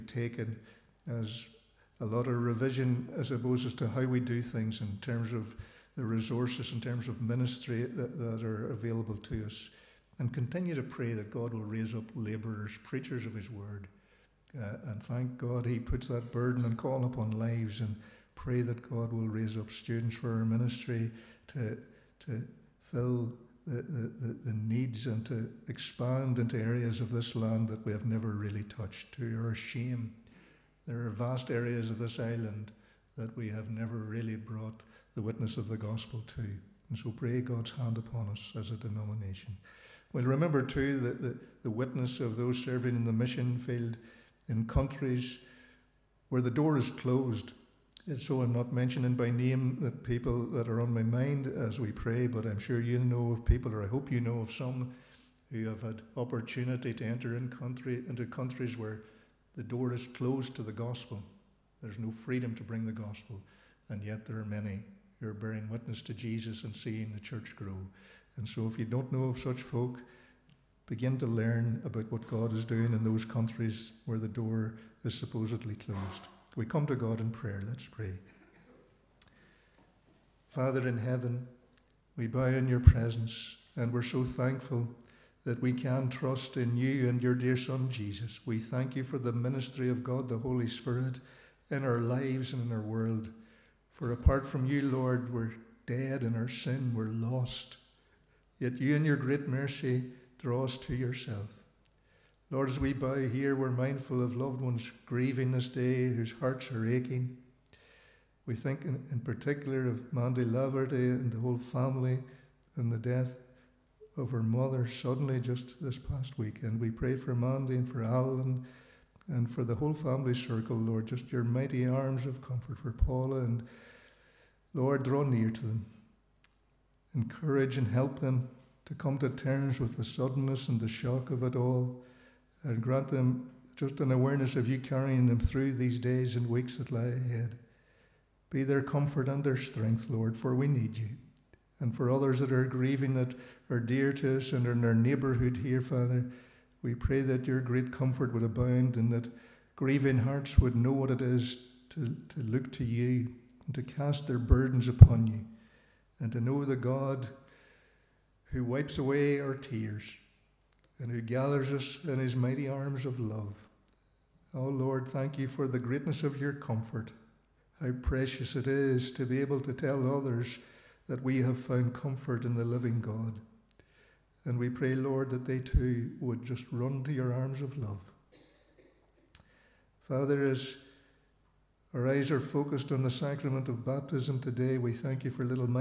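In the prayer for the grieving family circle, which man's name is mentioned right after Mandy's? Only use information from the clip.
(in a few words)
Alan.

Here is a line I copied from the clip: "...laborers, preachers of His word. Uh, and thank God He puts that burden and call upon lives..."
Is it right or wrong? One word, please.
right.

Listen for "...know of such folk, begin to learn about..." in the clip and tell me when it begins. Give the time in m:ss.
1:09.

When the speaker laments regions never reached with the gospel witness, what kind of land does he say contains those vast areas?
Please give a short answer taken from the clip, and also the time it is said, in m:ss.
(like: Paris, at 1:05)
island, at 0:32.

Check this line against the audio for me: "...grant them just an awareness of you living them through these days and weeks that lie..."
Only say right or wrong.
wrong.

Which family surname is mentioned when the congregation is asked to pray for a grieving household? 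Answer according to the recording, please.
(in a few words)
Laverty.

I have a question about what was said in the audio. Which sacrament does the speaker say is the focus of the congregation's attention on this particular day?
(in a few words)
baptism.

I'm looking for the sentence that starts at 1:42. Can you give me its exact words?
Lord, as we bow here, we're mindful of loved ones grieving this day whose hearts are aching.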